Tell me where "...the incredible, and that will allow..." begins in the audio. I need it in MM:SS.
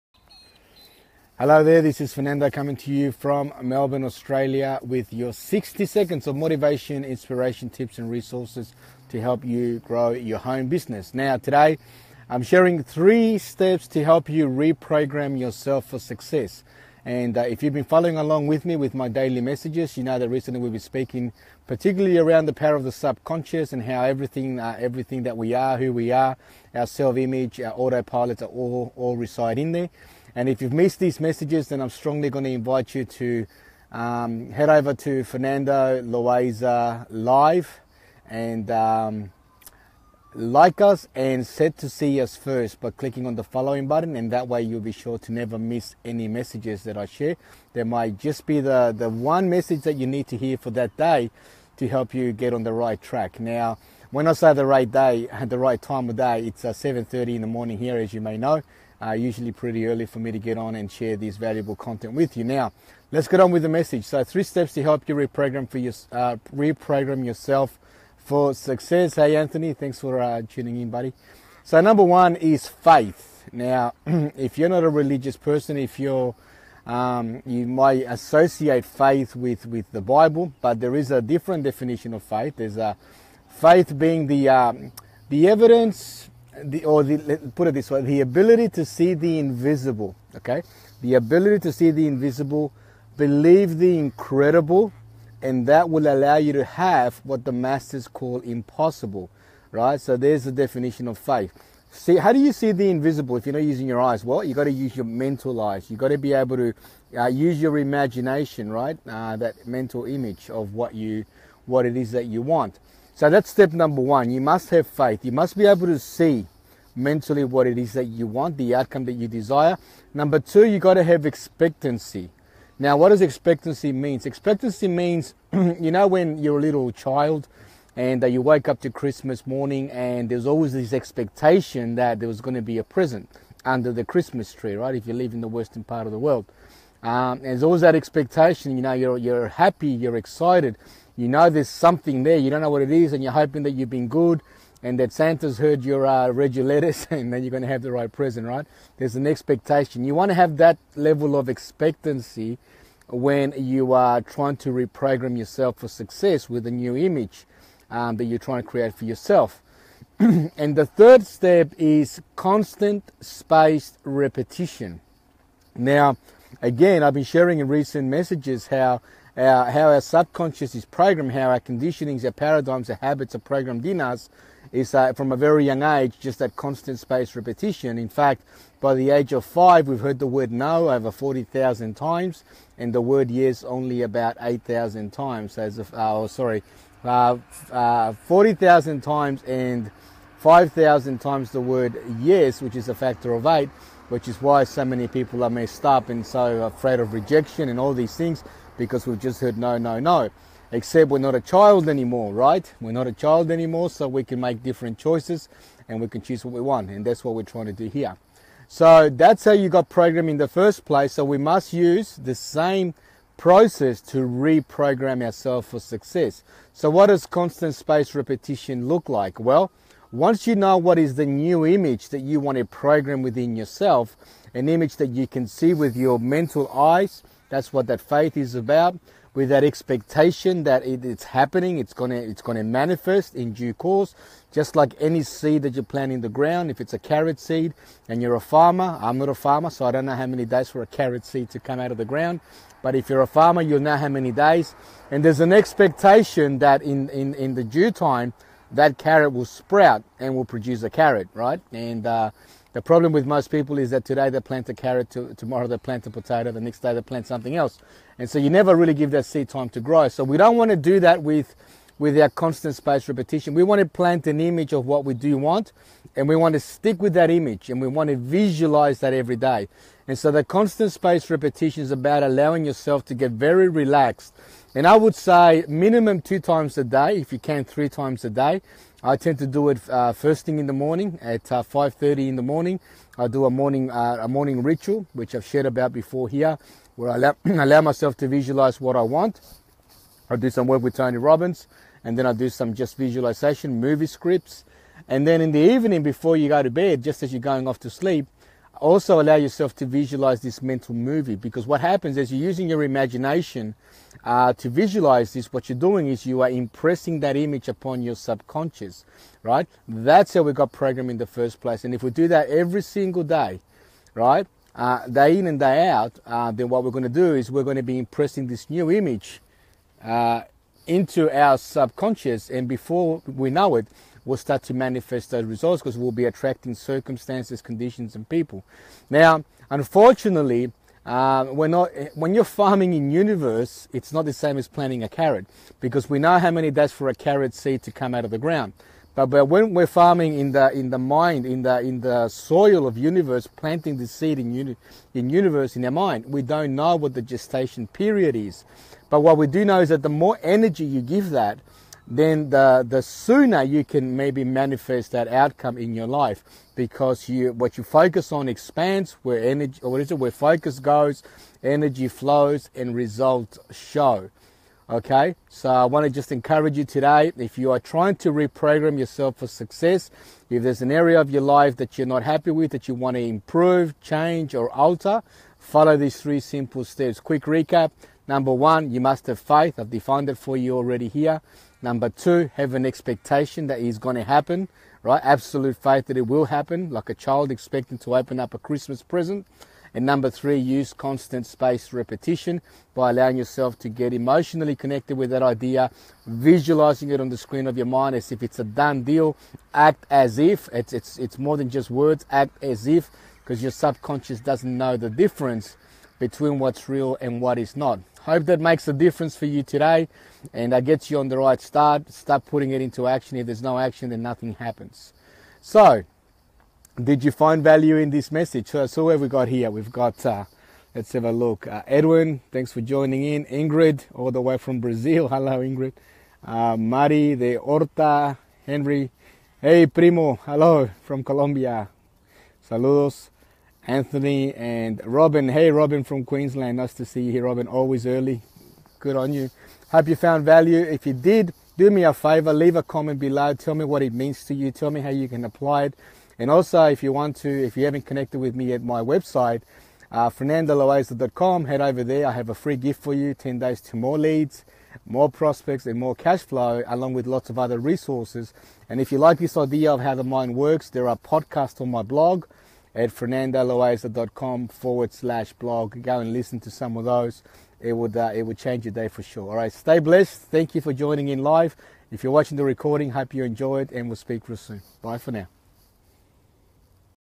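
01:33.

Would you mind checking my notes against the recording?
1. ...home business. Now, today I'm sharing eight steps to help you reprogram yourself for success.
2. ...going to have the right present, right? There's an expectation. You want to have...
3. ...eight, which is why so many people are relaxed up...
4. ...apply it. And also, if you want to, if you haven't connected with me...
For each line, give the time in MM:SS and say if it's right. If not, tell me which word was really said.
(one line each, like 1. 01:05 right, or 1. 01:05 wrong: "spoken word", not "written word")
1. 00:10 wrong: "three", not "eight"
2. 02:27 right
3. 03:13 wrong: "messed", not "relaxed"
4. 07:25 right.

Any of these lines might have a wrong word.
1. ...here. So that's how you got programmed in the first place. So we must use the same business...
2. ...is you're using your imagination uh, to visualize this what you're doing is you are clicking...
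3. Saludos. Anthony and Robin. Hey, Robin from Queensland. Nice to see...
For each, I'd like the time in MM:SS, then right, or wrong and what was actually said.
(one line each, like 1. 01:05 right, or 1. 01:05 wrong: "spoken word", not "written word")
1. 03:27 wrong: "process", not "business"
2. 05:02 wrong: "impressing", not "clicking"
3. 07:12 right.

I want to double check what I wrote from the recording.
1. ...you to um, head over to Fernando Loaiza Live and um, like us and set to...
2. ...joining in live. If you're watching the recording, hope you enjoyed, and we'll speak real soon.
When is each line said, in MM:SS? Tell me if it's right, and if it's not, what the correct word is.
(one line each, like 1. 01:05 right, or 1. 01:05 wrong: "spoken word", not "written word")
1. 00:32 right
2. 07:50 right.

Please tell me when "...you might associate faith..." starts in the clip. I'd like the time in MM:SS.
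01:17.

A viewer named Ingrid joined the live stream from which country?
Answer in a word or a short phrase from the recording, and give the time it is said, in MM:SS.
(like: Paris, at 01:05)
Brazil, at 07:04.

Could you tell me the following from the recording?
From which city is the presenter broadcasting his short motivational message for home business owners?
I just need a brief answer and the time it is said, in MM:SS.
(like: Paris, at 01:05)
Melbourne, at 00:03.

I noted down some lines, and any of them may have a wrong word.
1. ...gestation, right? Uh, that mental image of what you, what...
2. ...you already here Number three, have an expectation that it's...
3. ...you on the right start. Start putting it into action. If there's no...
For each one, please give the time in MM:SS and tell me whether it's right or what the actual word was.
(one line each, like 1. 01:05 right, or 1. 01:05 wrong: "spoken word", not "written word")
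1. 01:47 wrong: "imagination", not "gestation"
2. 06:20 wrong: "two", not "three"
3. 06:51 right.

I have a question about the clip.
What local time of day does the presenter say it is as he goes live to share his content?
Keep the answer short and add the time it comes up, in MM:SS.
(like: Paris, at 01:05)
7:30 in the morning, at 00:56.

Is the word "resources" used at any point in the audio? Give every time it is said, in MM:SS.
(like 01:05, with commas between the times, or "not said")
00:08, 07:37.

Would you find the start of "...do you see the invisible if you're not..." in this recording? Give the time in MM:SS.
01:42.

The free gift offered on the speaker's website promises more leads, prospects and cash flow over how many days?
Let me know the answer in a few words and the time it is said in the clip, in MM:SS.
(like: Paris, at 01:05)
10 days, at 07:33.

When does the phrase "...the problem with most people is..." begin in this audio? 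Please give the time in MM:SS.
04:12.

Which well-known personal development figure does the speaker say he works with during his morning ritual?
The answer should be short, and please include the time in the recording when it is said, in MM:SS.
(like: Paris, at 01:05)
Tony Robbins, at 04:50.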